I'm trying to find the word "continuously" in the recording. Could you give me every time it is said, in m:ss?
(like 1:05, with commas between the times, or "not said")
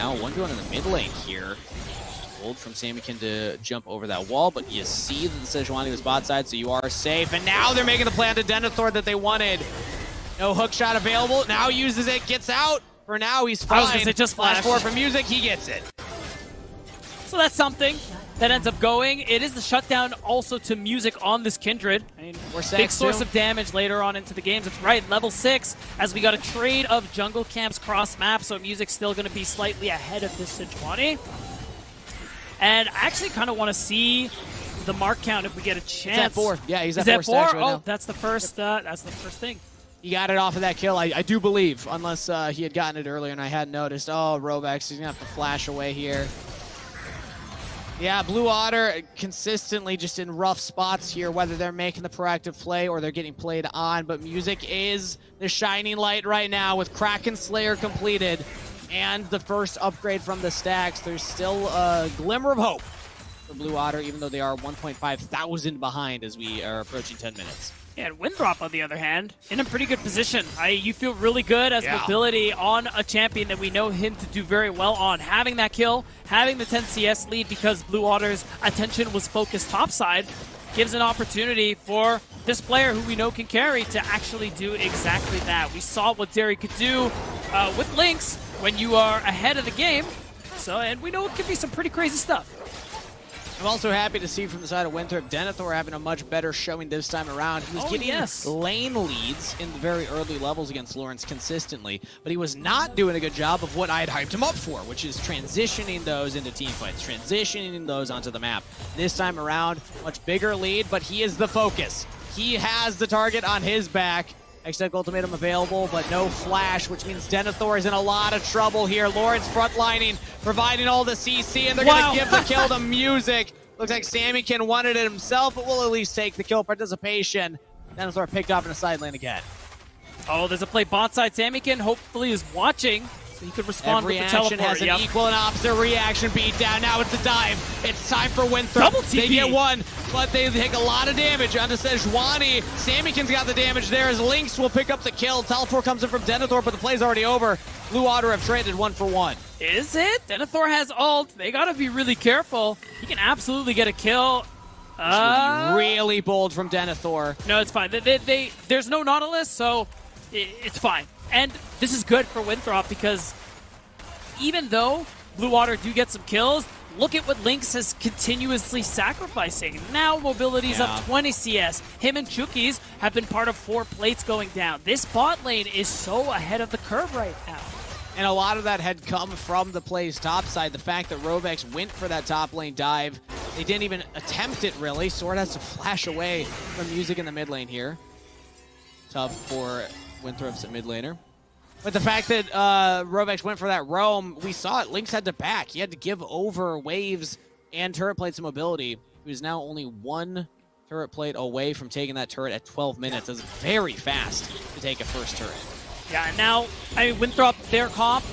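2:47.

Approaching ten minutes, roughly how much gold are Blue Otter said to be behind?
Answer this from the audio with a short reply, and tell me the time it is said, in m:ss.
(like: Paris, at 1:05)
1.5 thousand, at 1:04.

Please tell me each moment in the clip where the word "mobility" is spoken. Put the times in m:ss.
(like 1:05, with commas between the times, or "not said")
1:11, 2:50, 3:18.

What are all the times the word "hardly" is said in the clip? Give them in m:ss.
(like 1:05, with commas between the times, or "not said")
not said.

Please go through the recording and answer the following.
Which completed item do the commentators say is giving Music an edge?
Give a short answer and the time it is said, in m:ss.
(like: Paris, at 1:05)
Kraken Slayer, at 0:56.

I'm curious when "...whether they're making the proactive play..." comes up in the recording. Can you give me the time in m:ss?
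0:51.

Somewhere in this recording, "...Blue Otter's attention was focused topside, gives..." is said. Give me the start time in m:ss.
1:17.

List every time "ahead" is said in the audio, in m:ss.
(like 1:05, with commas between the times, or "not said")
0:29, 1:29, 2:56.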